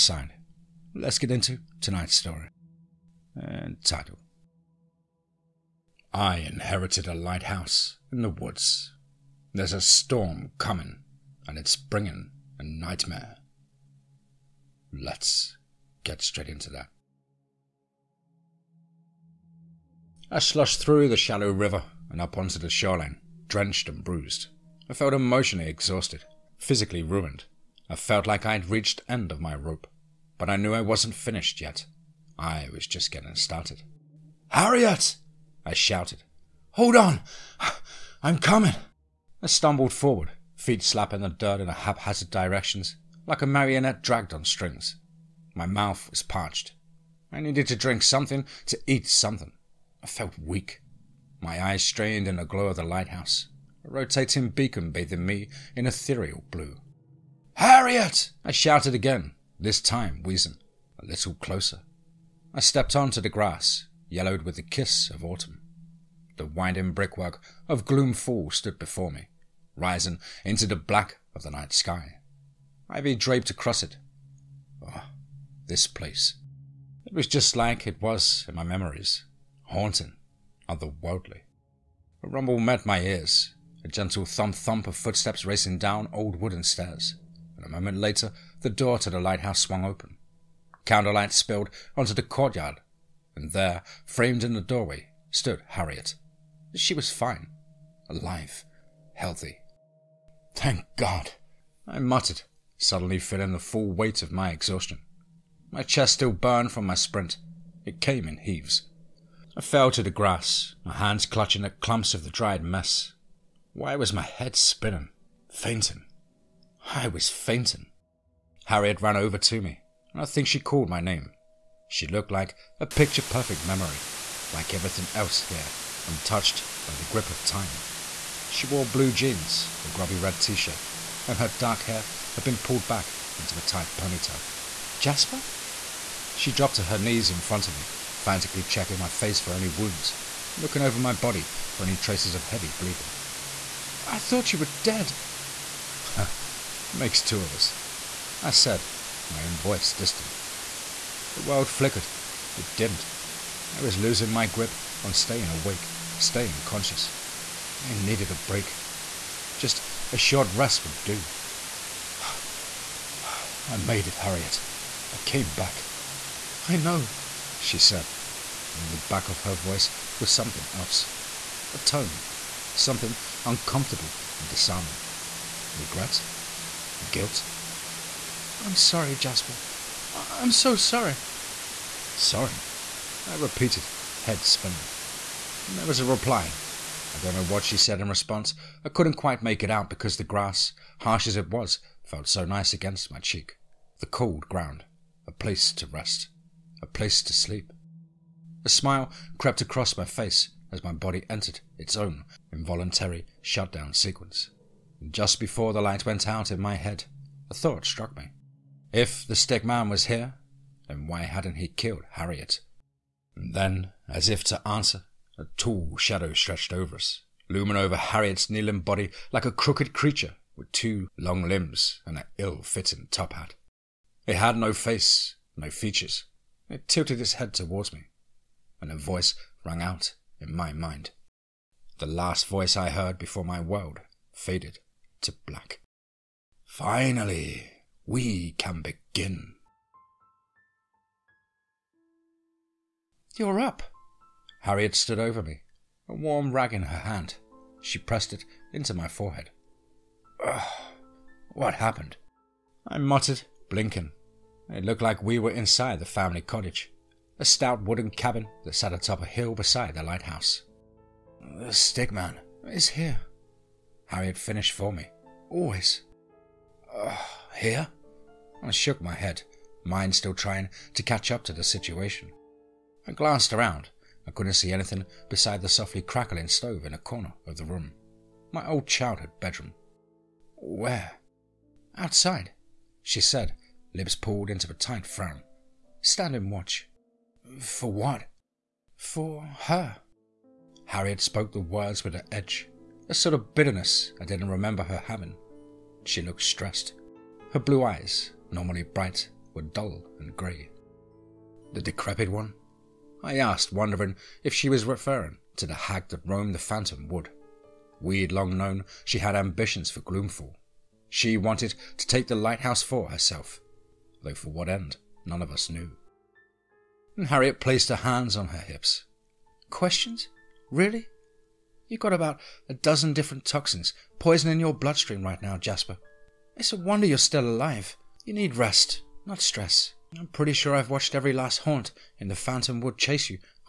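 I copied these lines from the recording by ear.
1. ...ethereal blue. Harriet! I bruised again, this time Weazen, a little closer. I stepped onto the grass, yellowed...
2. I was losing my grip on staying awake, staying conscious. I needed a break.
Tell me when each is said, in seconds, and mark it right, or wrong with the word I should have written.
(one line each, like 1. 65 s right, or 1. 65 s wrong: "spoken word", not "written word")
1. 55 s wrong: "shouted", not "bruised"
2. 153 s right.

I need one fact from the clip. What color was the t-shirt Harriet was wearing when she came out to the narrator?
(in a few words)
Red.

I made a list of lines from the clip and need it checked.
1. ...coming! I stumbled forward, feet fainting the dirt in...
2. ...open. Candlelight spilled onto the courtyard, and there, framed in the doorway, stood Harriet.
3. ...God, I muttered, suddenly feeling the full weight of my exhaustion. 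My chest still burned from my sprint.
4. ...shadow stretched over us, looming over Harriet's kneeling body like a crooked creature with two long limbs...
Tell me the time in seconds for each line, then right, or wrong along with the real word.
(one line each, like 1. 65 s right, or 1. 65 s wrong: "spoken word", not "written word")
1. 38 s wrong: "slapping", not "fainting"
2. 89 s right
3. 100 s right
4. 215 s right.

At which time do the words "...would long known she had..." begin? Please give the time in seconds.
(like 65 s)
308 s.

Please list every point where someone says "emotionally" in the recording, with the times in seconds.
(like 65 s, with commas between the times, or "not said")
25 s.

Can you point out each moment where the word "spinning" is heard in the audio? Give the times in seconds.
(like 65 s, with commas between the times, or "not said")
114 s, 184 s.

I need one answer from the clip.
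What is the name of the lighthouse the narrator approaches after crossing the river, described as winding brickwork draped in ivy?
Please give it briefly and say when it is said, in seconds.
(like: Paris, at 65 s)
Gloom Fall, at 67 s.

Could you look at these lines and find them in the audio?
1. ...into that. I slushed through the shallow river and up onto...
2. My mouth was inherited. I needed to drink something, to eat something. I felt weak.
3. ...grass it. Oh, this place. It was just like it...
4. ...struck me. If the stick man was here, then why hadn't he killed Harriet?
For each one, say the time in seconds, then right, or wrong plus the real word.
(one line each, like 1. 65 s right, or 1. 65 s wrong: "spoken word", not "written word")
1. 16 s right
2. 45 s wrong: "parched", not "inherited"
3. 73 s wrong: "across", not "grass"
4. 207 s right.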